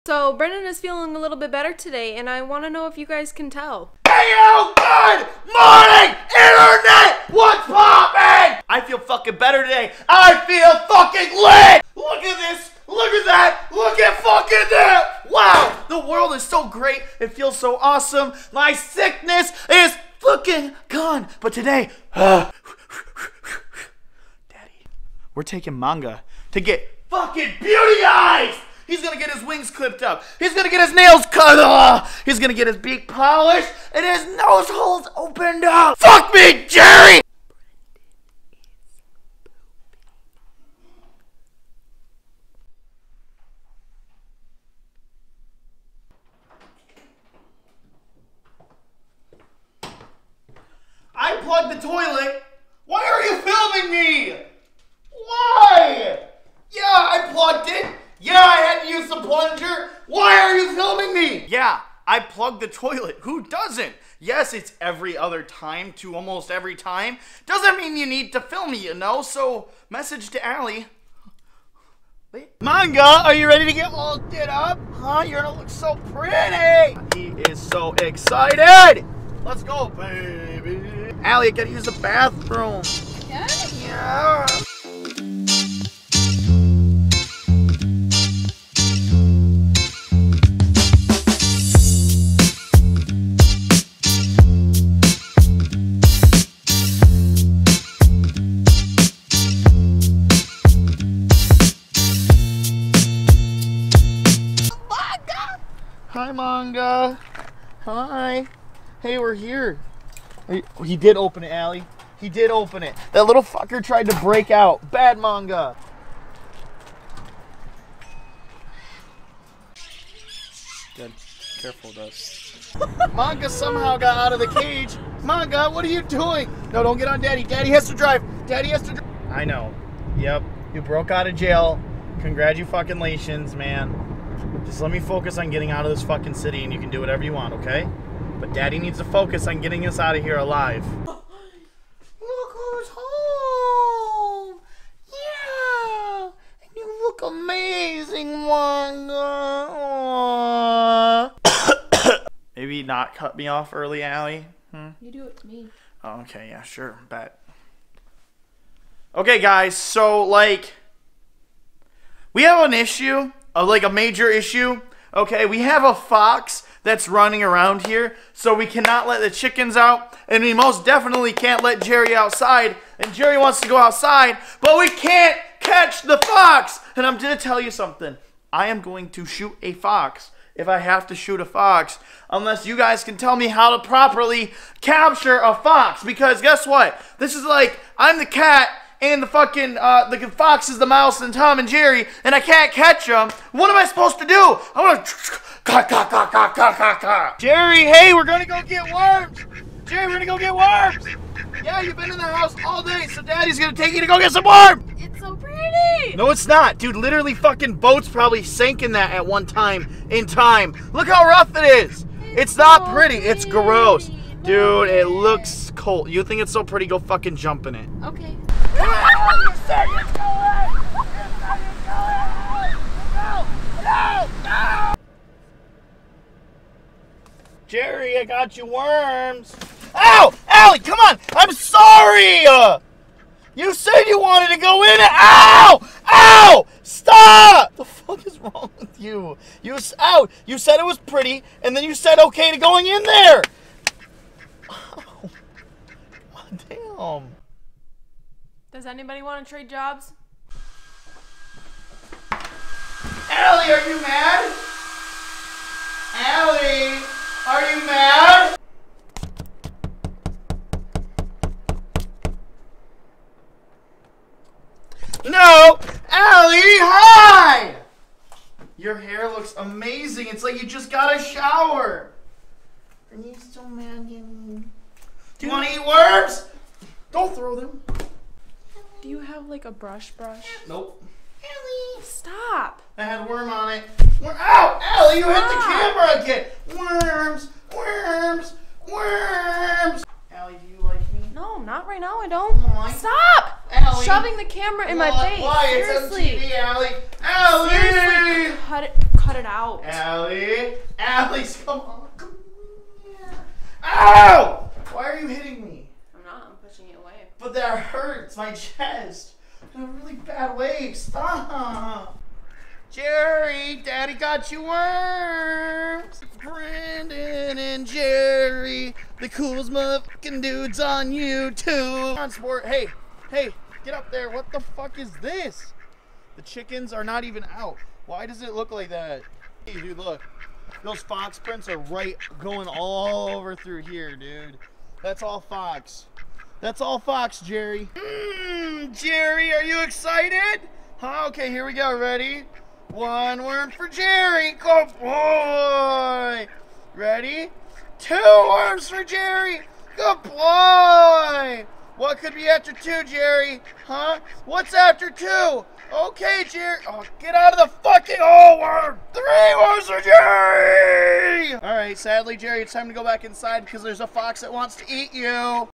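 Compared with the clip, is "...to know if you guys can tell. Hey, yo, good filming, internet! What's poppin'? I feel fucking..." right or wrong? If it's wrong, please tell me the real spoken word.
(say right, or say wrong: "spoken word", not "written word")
wrong: "morning", not "filming".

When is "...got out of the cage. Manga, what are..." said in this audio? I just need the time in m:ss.
2:03.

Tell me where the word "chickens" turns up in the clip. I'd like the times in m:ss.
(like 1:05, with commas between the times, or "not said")
2:49, 5:26.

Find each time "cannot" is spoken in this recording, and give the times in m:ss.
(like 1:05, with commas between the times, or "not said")
2:48.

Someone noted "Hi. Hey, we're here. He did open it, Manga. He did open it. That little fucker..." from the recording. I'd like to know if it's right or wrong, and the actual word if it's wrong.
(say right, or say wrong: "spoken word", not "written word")
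wrong: "Allie", not "Manga".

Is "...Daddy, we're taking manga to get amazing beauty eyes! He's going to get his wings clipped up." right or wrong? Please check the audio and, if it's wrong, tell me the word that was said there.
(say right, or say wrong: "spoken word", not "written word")
wrong: "fucking", not "amazing".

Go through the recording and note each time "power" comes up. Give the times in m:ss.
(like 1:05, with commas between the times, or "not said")
not said.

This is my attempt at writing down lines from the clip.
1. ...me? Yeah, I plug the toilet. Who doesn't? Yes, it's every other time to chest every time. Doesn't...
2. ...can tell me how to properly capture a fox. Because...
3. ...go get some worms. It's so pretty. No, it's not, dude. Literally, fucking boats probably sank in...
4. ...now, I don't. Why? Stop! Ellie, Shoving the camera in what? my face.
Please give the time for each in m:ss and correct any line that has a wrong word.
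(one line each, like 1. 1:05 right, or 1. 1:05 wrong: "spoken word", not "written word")
1. 1:01 wrong: "almost", not "chest"
2. 3:03 right
3. 3:24 right
4. 4:51 right.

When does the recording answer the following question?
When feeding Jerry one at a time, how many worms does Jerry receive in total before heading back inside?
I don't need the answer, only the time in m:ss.
5:59.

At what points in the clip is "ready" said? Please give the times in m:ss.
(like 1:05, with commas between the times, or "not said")
1:13, 5:41, 5:46.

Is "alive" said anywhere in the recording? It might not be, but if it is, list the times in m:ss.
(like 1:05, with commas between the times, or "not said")
2:20.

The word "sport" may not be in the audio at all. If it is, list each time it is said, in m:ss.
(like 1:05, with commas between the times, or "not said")
5:22.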